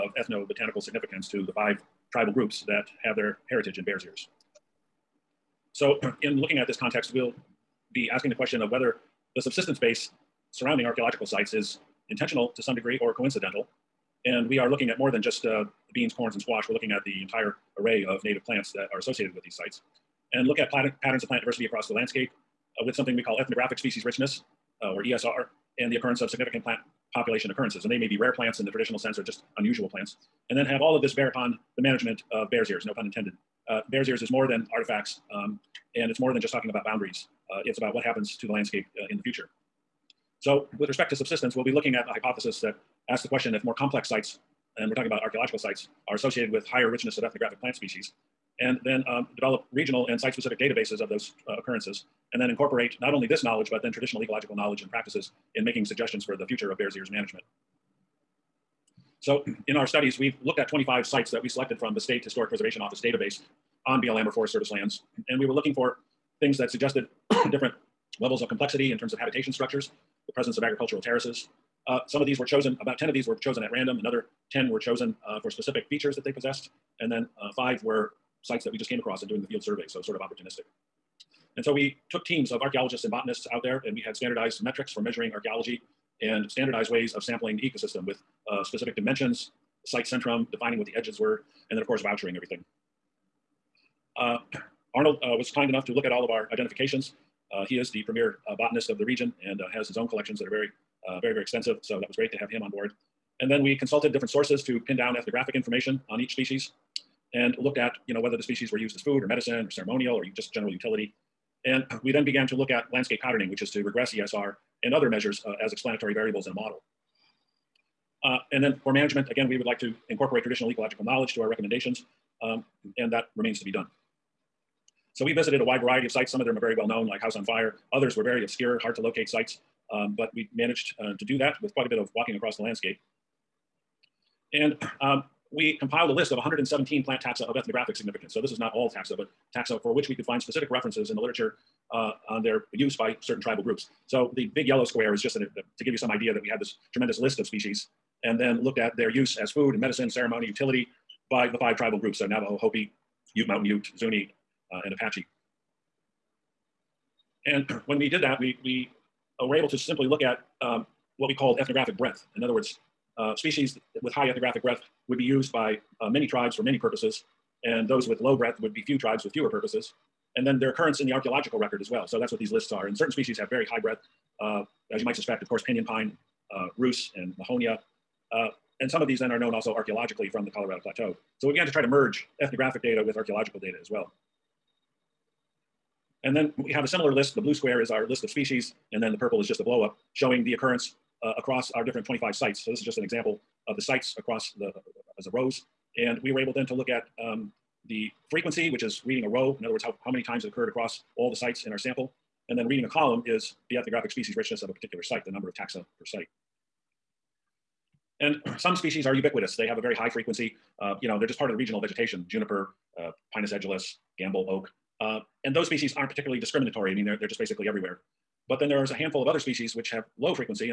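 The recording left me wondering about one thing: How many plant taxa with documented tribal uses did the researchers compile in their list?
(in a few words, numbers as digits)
117.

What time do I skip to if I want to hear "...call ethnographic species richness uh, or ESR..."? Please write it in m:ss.
0:23.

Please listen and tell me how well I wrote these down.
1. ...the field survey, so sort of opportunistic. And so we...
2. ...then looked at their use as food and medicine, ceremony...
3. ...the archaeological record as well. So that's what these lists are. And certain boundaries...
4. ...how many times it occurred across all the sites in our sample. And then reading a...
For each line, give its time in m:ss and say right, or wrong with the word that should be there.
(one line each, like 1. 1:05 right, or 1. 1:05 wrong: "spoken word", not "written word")
1. 1:19 right
2. 2:28 right
3. 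2:51 wrong: "species", not "boundaries"
4. 3:20 right.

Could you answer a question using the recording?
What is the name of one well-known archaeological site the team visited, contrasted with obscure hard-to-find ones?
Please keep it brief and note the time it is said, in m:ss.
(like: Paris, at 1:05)
House on Fire, at 2:07.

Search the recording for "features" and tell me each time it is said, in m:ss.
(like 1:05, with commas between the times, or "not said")
1:15.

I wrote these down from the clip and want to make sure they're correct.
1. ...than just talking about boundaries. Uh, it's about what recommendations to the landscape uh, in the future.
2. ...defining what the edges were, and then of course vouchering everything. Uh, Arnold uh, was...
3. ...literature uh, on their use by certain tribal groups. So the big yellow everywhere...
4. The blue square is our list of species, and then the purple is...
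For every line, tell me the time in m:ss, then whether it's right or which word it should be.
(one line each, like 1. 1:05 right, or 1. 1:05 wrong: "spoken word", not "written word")
1. 0:36 wrong: "happens", not "recommendations"
2. 1:30 right
3. 2:21 wrong: "square", not "everywhere"
4. 3:07 right.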